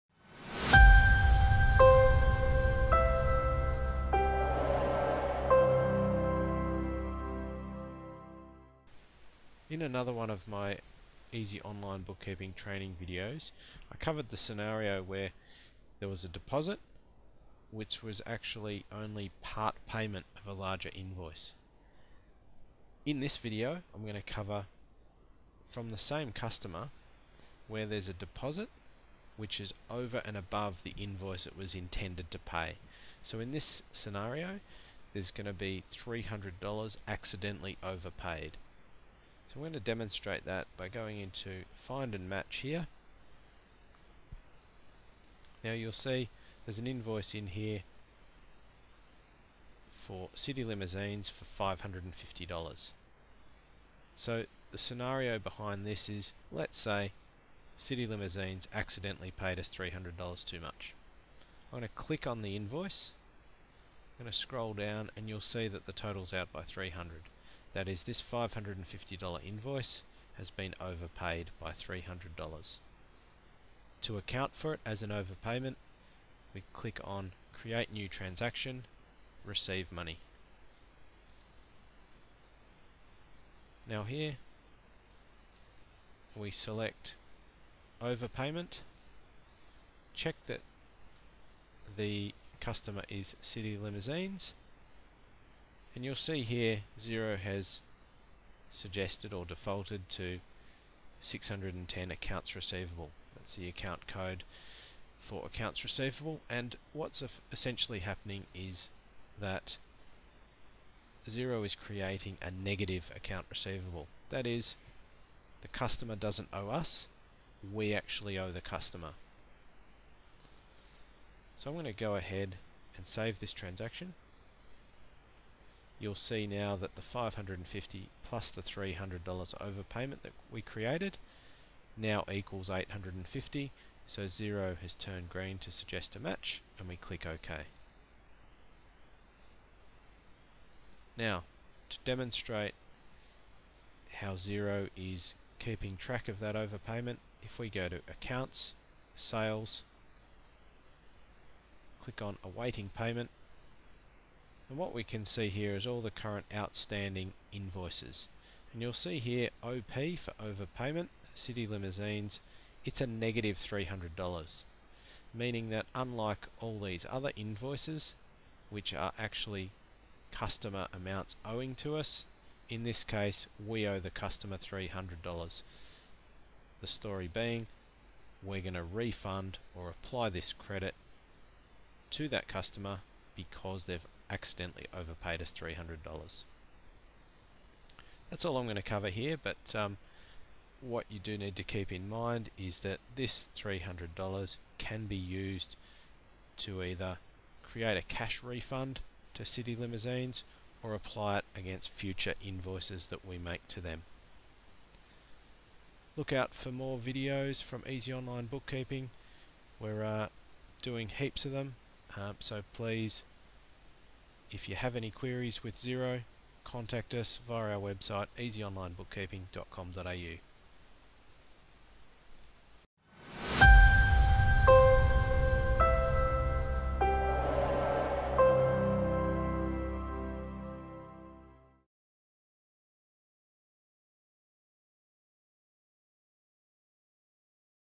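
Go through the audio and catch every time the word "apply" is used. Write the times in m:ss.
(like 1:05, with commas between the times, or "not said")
2:59, 3:20.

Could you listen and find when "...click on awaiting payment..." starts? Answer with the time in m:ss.
2:32.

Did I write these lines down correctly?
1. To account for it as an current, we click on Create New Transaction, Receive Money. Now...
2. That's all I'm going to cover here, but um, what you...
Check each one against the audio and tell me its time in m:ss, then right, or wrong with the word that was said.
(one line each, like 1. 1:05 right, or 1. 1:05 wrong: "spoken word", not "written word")
1. 1:14 wrong: "overpayment", not "current"
2. 3:08 right.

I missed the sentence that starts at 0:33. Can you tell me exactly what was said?
So in this scenario, there's going to be $300 accidentally overpaid.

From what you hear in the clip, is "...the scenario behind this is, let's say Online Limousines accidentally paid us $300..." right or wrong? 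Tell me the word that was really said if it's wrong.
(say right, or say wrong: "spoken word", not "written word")
wrong: "City", not "Online".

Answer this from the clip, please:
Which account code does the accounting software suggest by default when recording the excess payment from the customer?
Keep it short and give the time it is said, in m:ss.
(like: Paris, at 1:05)
610, at 1:41.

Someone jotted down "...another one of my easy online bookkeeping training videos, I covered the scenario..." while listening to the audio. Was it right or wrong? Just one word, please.
right.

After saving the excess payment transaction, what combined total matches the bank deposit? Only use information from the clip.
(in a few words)
850.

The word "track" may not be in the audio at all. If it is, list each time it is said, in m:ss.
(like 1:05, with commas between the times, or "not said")
2:25.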